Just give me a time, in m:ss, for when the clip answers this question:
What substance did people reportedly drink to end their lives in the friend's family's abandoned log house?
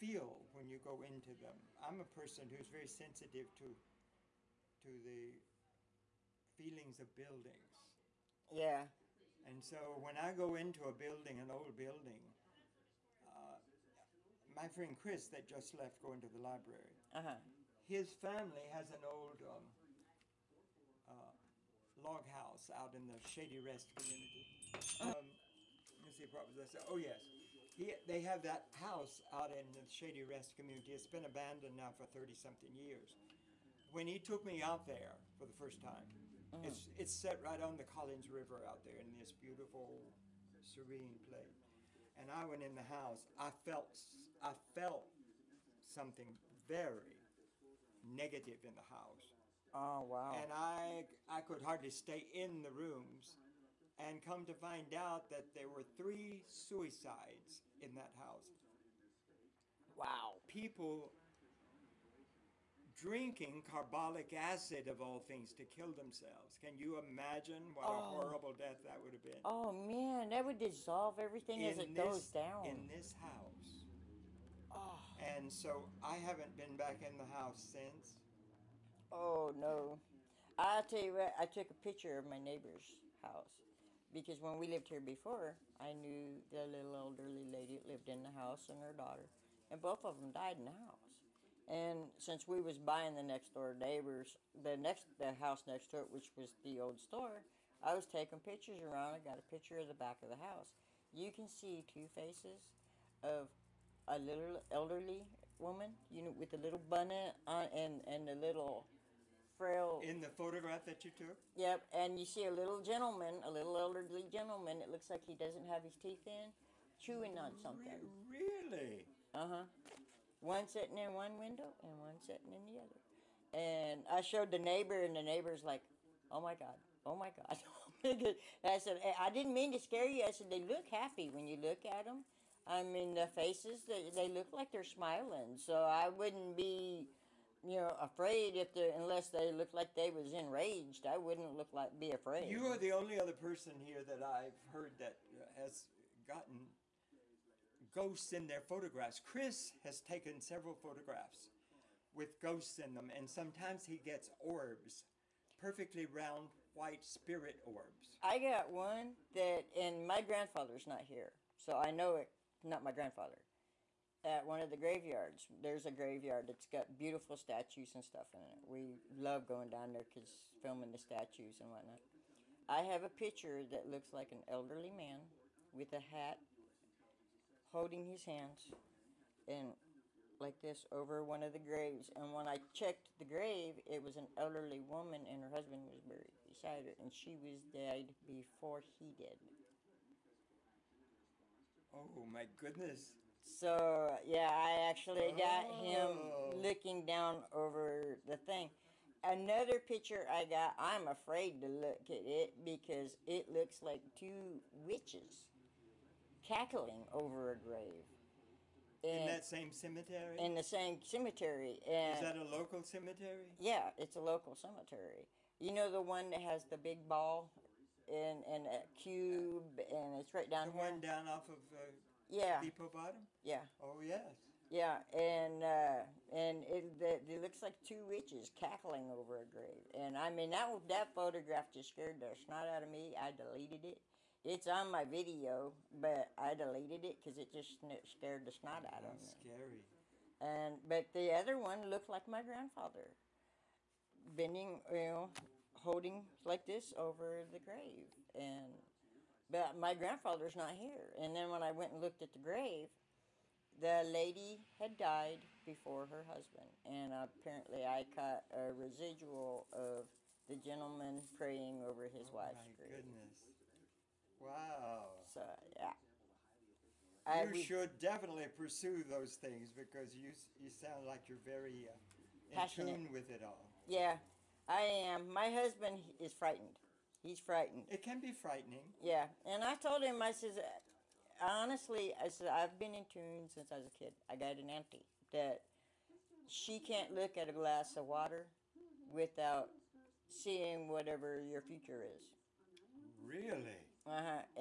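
1:03.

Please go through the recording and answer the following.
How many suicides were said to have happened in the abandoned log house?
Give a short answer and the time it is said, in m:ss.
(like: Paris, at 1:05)
3, at 0:55.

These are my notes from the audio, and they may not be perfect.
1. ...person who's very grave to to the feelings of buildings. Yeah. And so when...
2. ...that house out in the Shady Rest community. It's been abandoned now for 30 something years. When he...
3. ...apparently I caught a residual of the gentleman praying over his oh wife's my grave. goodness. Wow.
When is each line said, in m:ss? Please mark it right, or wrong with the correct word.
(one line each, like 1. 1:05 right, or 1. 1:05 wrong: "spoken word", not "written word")
1. 0:02 wrong: "sensitive", not "grave"
2. 0:28 right
3. 4:17 right.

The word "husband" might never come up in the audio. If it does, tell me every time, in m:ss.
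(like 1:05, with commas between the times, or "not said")
3:05, 4:16, 4:35.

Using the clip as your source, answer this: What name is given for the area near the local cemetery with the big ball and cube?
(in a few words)
Depot Bottom.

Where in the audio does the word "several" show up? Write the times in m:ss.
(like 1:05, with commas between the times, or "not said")
2:30.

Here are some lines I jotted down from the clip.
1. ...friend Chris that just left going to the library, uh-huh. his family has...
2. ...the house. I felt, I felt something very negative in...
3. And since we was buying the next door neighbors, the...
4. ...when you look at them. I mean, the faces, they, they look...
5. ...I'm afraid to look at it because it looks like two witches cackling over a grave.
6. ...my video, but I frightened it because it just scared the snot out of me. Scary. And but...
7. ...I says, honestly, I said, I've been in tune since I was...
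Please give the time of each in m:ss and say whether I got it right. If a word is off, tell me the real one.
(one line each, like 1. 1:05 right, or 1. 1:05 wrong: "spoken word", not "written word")
1. 0:14 right
2. 0:42 right
3. 1:31 right
4. 2:11 right
5. 3:20 right
6. 3:54 wrong: "deleted", not "frightened"
7. 4:40 right.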